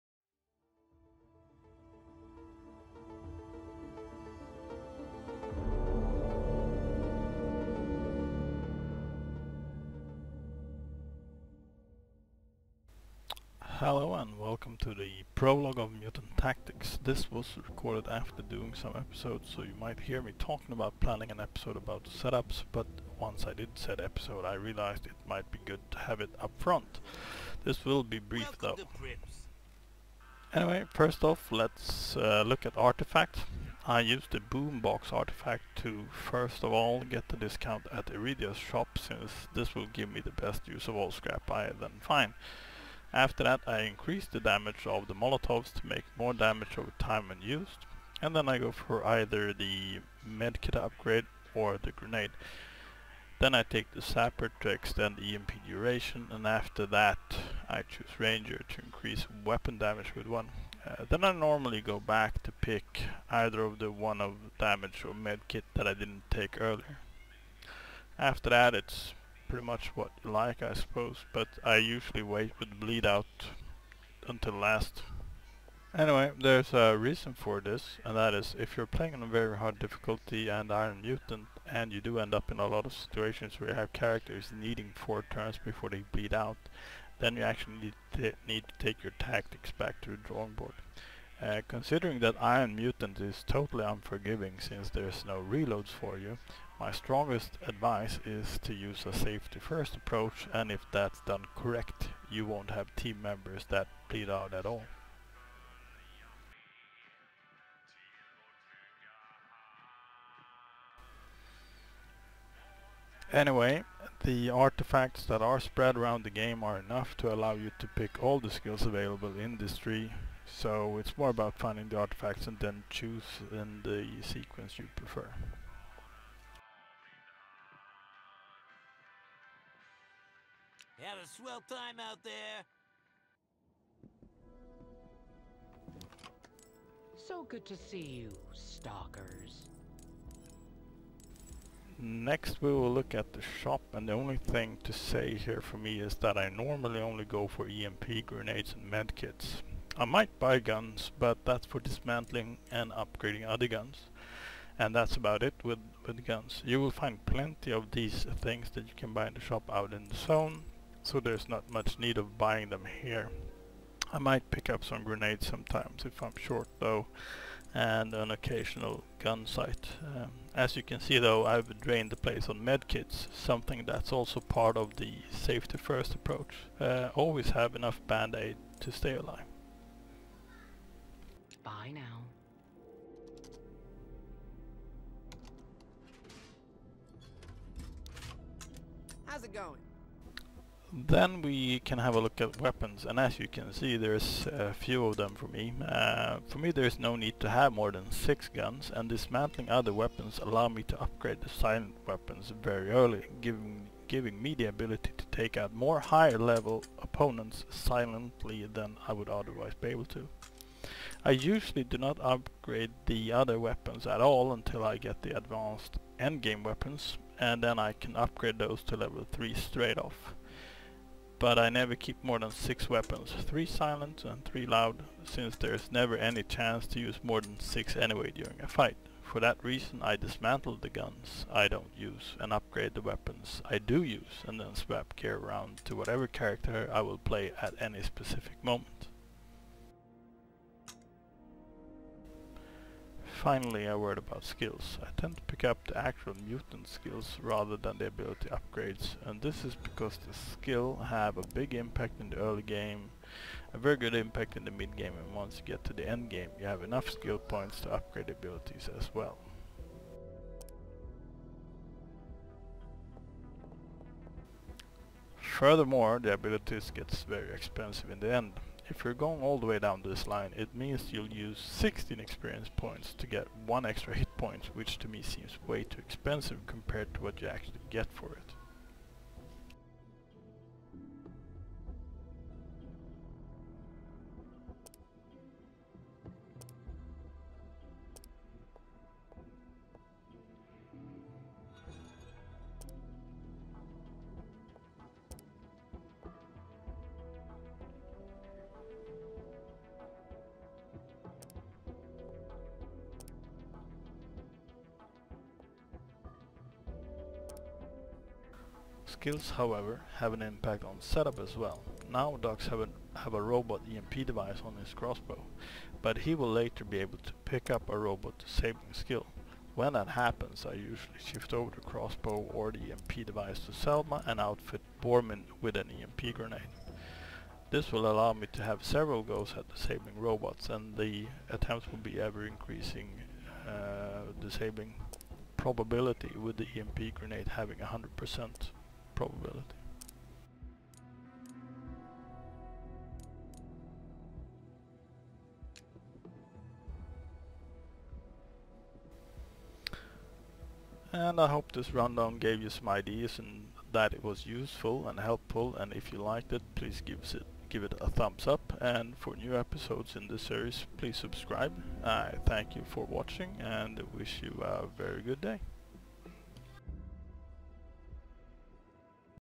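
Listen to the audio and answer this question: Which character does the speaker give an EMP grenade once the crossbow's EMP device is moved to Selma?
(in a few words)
Bormin.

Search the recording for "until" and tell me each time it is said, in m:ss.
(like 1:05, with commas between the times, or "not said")
1:14, 3:34.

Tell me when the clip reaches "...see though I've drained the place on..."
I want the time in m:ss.
2:50.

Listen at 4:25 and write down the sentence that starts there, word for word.
Furthermore, the abilities gets very expensive in the end.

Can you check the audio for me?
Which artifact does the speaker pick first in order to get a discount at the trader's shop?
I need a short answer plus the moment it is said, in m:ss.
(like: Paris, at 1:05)
Boombox, at 0:34.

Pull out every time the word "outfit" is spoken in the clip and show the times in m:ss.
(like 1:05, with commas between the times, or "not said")
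5:24.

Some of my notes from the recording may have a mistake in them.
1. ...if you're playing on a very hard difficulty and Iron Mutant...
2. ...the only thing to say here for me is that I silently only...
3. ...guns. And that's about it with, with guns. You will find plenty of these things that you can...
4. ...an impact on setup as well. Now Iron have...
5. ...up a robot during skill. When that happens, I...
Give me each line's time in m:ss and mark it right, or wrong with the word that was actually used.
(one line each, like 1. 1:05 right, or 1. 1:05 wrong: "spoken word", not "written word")
1. 1:18 right
2. 2:24 wrong: "normally", not "silently"
3. 2:33 right
4. 5:10 wrong: "Dux", not "Iron"
5. 5:17 wrong: "disabling", not "during".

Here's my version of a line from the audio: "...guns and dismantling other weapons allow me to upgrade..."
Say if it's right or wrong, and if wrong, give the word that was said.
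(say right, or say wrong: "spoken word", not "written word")
right.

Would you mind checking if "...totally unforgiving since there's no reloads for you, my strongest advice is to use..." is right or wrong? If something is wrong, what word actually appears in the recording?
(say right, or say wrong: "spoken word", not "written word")
right.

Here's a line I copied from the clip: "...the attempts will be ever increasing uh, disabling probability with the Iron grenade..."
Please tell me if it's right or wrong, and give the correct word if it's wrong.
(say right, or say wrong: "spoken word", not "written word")
wrong: "EMP", not "Iron".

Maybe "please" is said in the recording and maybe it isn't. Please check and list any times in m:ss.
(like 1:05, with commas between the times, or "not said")
5:56, 6:00.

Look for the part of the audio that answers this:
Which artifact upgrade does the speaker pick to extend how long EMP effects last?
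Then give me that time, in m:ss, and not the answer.
0:54.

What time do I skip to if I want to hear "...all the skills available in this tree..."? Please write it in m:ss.
1:58.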